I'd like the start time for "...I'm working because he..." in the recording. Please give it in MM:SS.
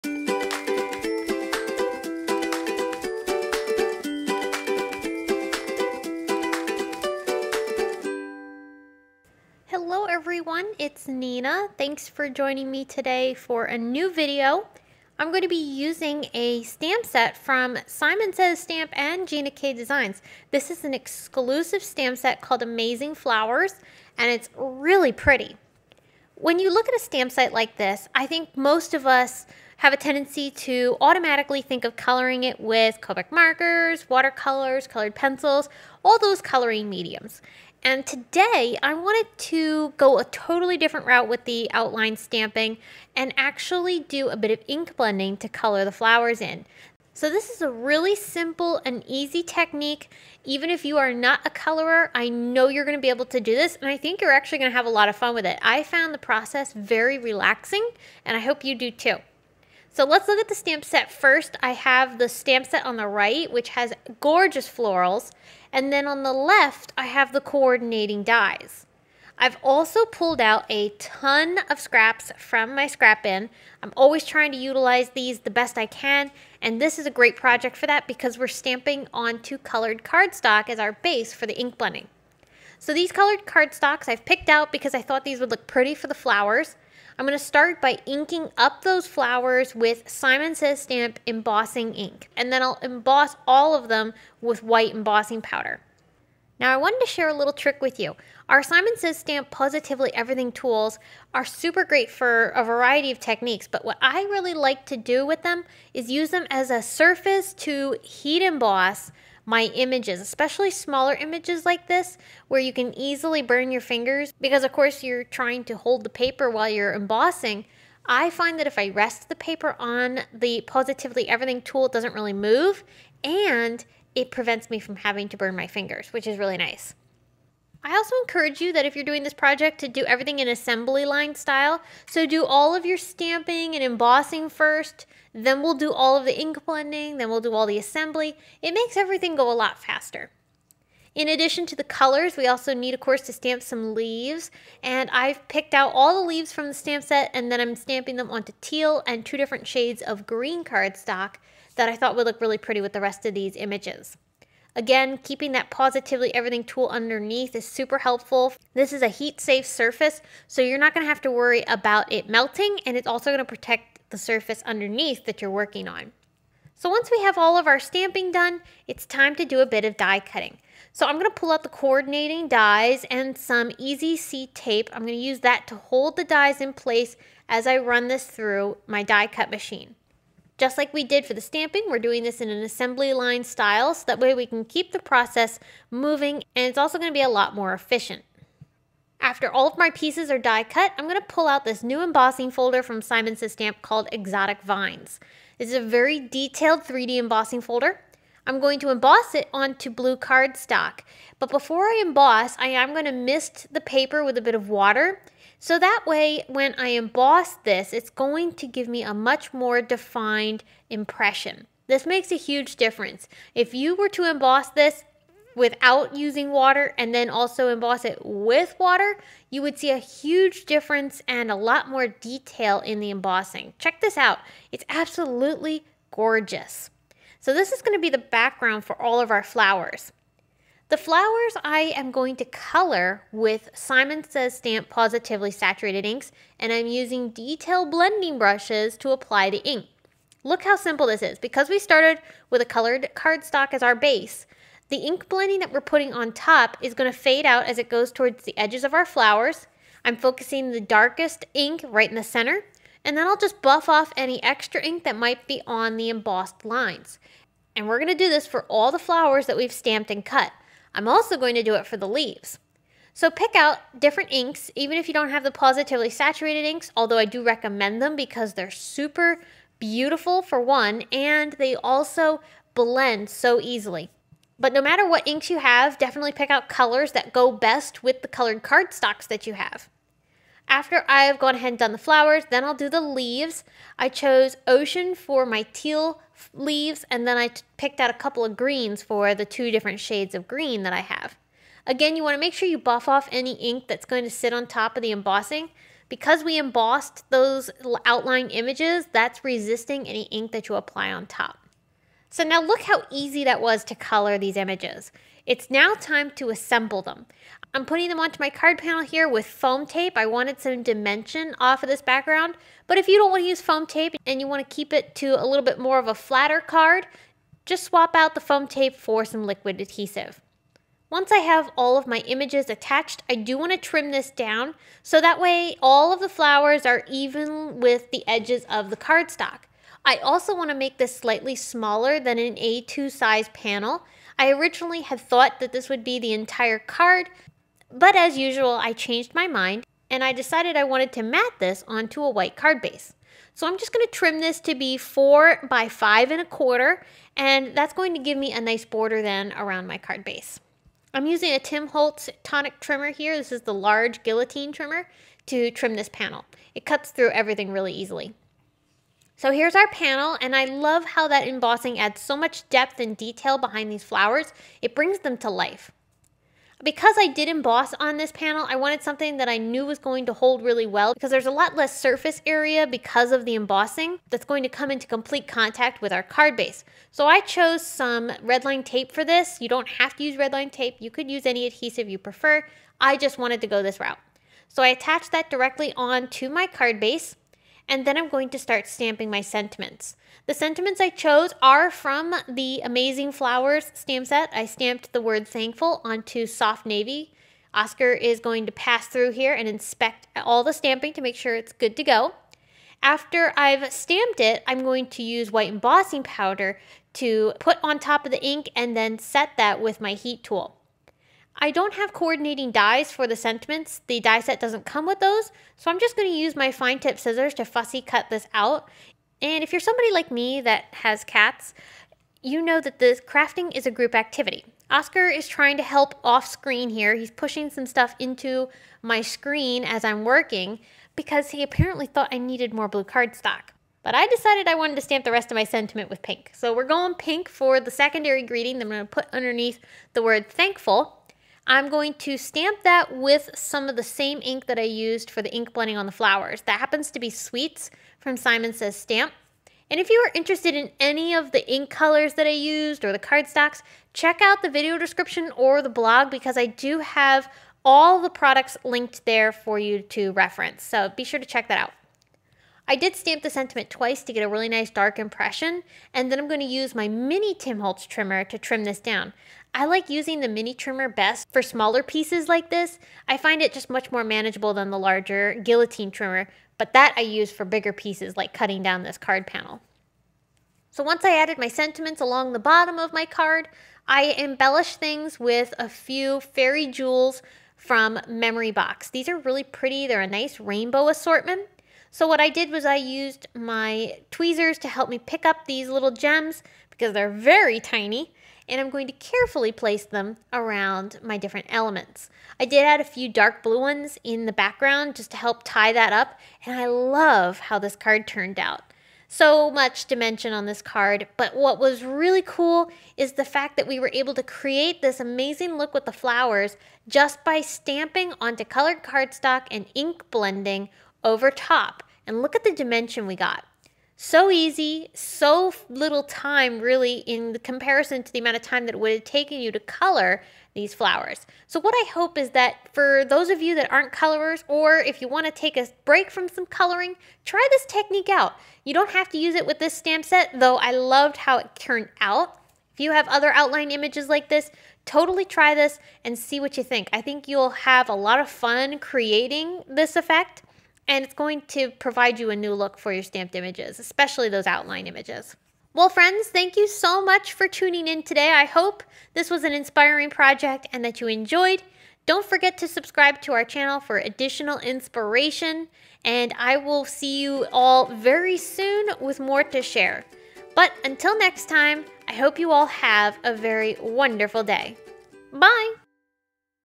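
07:10.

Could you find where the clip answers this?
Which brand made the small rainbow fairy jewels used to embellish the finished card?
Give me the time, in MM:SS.
08:08.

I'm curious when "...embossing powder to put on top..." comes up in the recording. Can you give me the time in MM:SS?
06:45.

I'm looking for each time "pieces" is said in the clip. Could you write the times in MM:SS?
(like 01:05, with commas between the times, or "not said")
03:09, 07:52, 07:57.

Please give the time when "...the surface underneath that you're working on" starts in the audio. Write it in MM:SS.
02:44.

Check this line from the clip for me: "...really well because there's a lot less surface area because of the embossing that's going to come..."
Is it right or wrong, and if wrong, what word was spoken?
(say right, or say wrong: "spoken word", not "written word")
right.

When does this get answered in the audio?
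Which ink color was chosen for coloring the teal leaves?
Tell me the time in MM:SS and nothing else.
04:44.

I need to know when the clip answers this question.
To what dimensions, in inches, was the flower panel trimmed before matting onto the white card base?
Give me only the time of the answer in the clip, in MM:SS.
05:44.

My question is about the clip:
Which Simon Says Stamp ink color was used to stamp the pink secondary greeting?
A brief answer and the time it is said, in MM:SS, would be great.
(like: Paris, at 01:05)
Sweets, at 07:27.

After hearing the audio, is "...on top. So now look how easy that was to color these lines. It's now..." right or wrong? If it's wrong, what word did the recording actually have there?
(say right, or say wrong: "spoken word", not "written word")
wrong: "images", not "lines".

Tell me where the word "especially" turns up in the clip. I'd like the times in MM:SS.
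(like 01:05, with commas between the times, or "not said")
01:50, 09:13.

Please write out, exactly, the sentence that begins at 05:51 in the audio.
I'm using a Tim Holtz tonic trimmer here.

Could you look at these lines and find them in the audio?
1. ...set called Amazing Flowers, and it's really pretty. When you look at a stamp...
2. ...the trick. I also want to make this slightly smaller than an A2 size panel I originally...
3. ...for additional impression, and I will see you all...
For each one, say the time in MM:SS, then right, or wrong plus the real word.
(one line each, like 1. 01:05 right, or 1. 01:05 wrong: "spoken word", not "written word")
1. 00:22 right
2. 05:28 wrong: "cardstock", not "trick"
3. 09:23 wrong: "inspiration", not "impression".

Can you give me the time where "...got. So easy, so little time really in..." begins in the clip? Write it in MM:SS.
08:43.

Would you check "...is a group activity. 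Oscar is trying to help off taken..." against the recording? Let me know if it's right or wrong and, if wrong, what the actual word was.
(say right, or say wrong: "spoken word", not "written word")
wrong: "screen", not "taken".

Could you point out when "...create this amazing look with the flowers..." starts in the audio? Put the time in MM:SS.
08:34.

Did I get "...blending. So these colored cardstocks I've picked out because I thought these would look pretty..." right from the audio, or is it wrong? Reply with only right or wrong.
right.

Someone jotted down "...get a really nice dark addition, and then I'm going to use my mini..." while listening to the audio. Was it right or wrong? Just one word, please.
wrong.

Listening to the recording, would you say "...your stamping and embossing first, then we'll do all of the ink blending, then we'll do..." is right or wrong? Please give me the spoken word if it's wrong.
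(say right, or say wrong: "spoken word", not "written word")
right.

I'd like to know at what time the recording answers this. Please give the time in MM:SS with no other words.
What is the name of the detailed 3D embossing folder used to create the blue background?
03:14.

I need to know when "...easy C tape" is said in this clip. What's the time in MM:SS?
02:53.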